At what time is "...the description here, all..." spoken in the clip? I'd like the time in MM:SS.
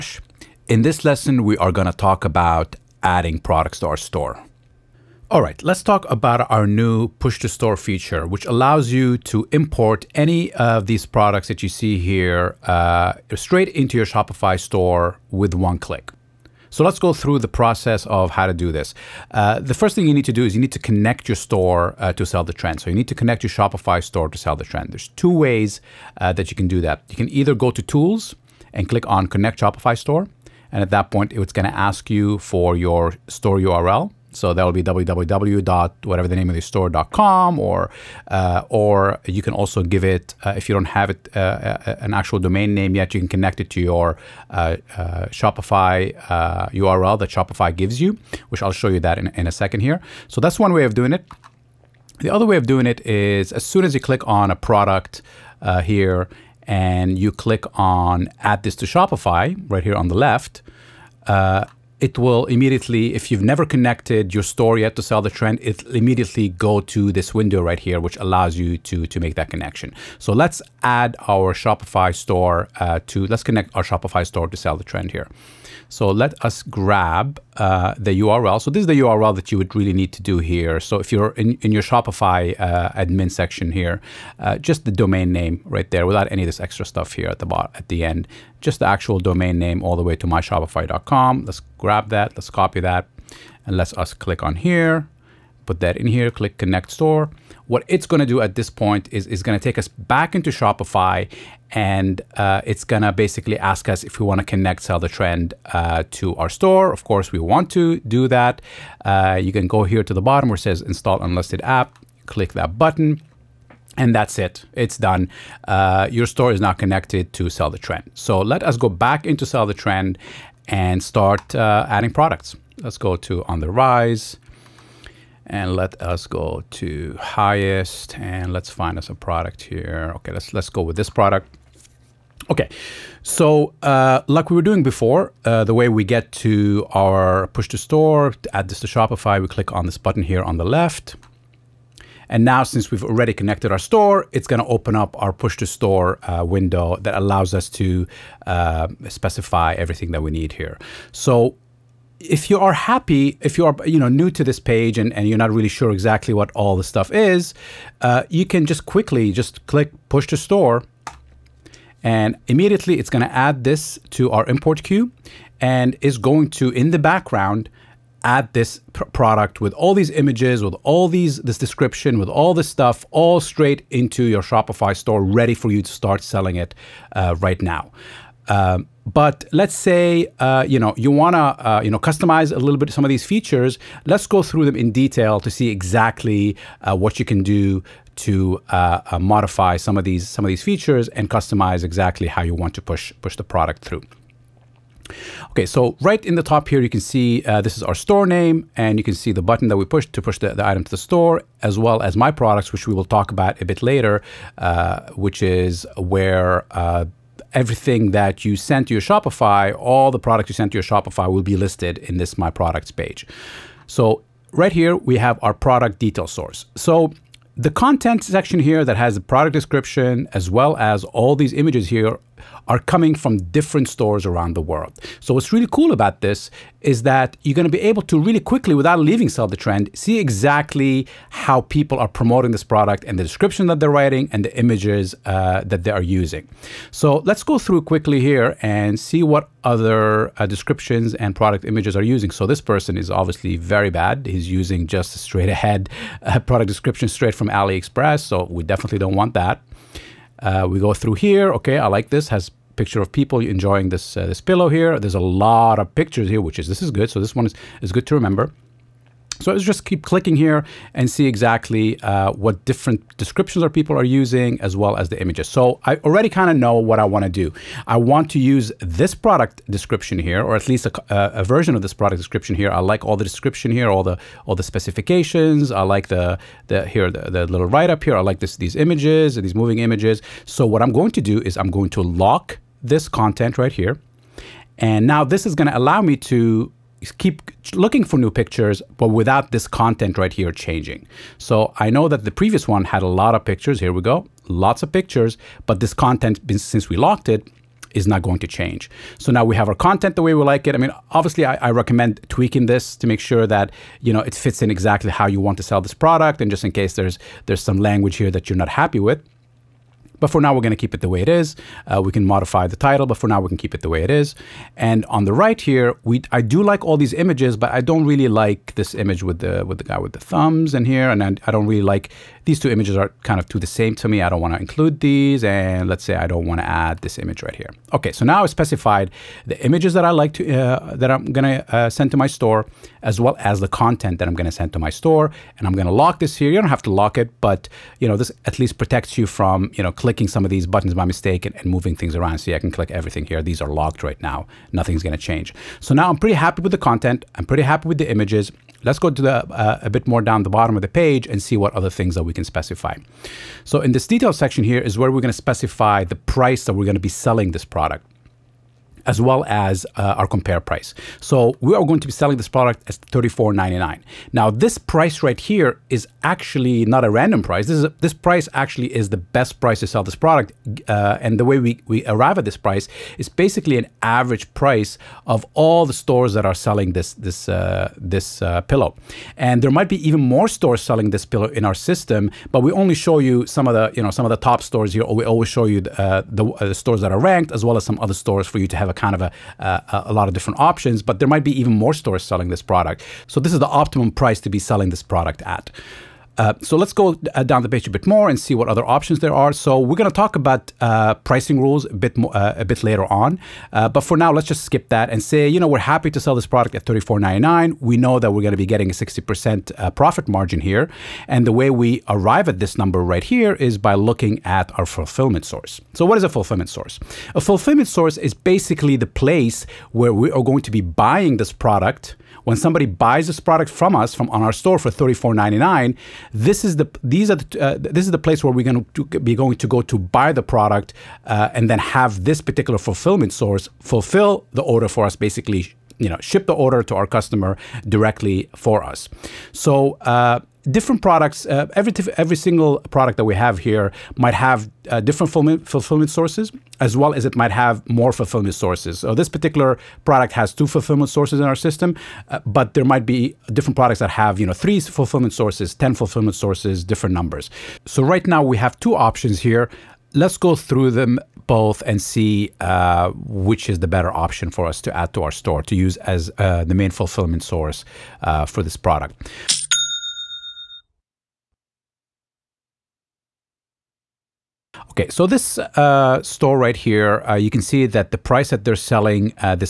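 04:33.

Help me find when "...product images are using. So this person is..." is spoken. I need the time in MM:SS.
04:01.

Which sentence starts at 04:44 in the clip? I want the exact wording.
And now this is going to allow me to keep looking for new pictures, but without this content right here changing.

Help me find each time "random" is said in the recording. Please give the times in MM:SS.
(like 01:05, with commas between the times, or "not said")
06:07.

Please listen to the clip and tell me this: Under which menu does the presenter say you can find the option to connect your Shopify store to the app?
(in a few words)
Tools.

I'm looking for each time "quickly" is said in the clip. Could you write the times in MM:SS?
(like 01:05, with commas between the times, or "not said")
02:38, 03:48, 03:57.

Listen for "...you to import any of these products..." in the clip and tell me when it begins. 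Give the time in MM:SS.
00:08.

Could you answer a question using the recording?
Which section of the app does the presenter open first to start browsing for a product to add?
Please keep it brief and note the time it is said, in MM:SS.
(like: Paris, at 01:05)
On the Rise, at 02:03.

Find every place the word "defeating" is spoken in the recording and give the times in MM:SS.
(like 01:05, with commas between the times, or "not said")
not said.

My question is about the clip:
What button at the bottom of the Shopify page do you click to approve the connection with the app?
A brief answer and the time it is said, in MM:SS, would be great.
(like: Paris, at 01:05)
Install unlisted app, at 01:50.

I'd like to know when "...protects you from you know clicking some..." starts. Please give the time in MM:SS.
05:38.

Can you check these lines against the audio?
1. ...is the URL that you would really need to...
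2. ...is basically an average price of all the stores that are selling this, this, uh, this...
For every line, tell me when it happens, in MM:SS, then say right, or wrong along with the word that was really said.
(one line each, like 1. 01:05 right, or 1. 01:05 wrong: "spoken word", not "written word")
1. 01:18 right
2. 06:13 right.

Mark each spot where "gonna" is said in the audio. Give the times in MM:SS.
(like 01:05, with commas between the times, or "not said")
02:24.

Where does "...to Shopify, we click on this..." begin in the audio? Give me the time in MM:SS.
02:18.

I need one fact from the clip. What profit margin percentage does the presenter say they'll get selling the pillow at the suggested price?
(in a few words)
60%.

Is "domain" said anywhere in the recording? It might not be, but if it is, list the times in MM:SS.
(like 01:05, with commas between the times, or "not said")
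00:42, 01:24, 01:29.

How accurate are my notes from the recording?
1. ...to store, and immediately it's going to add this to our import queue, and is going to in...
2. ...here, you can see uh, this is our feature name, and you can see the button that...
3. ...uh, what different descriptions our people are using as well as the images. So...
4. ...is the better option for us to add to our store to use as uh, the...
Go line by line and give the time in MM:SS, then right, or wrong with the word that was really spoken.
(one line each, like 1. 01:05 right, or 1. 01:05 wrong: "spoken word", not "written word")
1. 02:40 right
2. 03:16 wrong: "store", not "feature"
3. 04:22 right
4. 07:43 right.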